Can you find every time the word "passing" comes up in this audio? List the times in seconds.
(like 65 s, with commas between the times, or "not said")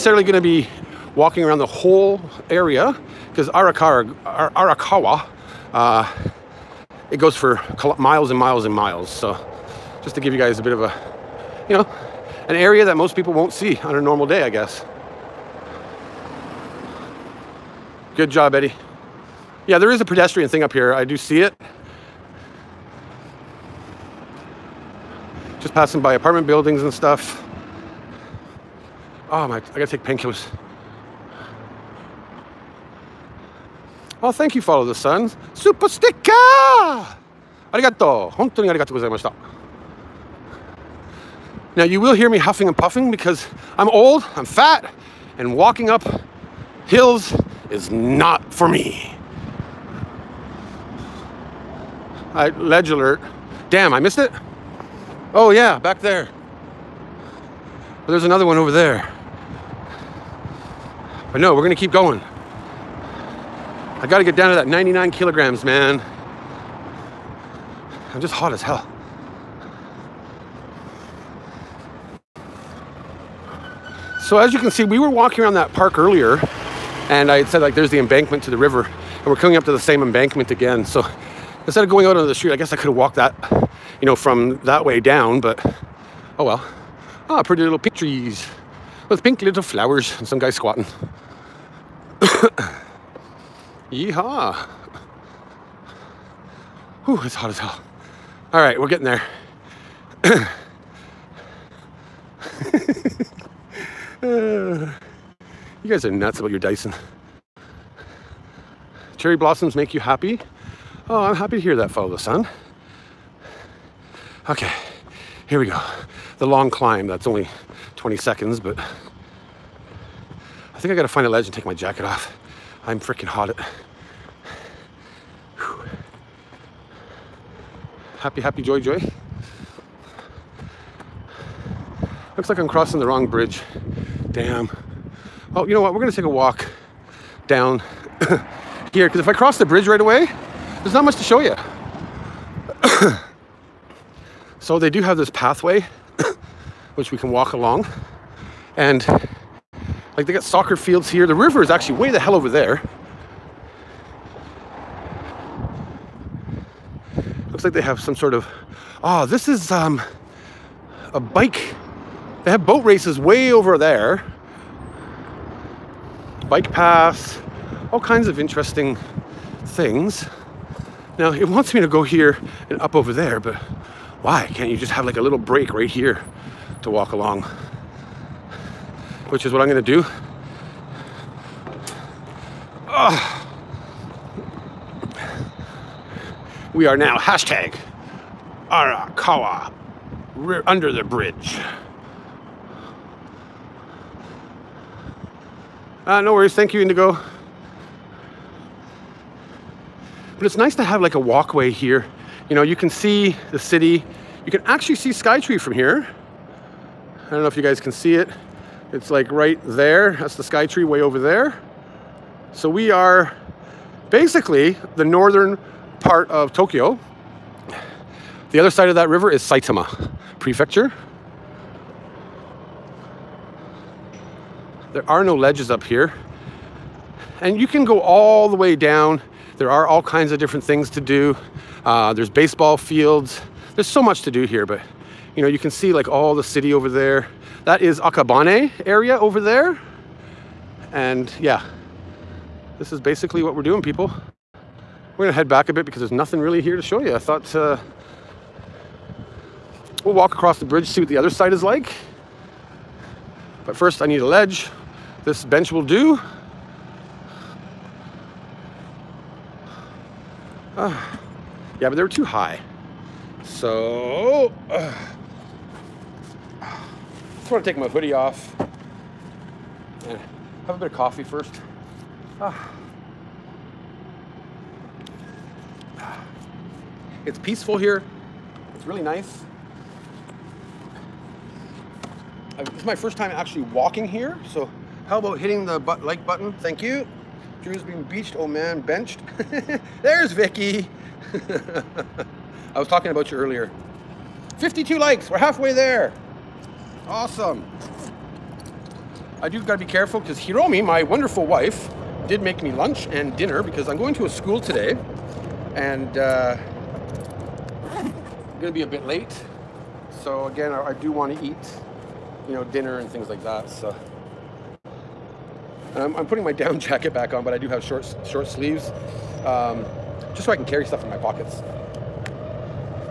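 25 s.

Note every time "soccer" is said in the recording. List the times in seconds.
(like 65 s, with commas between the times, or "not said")
150 s.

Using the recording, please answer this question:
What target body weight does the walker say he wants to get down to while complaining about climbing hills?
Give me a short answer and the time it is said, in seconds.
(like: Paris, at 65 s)
99 kilograms, at 64 s.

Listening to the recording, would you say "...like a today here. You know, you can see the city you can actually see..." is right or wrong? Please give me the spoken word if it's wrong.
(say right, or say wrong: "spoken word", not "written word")
wrong: "walkway", not "today".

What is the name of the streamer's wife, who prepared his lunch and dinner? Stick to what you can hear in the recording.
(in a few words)
Hiromi.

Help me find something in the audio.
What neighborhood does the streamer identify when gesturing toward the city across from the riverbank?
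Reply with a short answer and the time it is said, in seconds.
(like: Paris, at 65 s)
Akabane, at 237 s.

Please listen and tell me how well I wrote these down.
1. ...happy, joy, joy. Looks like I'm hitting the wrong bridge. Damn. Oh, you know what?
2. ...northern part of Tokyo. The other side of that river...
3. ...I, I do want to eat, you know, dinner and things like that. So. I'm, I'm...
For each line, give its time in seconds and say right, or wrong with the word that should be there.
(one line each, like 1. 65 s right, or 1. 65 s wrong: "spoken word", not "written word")
1. 128 s wrong: "crossing", not "hitting"
2. 215 s right
3. 310 s right.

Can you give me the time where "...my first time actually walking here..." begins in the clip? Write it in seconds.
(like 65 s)
282 s.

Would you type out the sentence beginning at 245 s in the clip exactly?
We're gonna head back a bit because there's nothing really here to show you.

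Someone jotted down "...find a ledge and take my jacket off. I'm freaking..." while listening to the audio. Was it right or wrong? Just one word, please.
right.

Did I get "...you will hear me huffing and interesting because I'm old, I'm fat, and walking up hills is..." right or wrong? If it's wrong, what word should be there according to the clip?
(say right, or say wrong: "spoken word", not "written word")
wrong: "puffing", not "interesting".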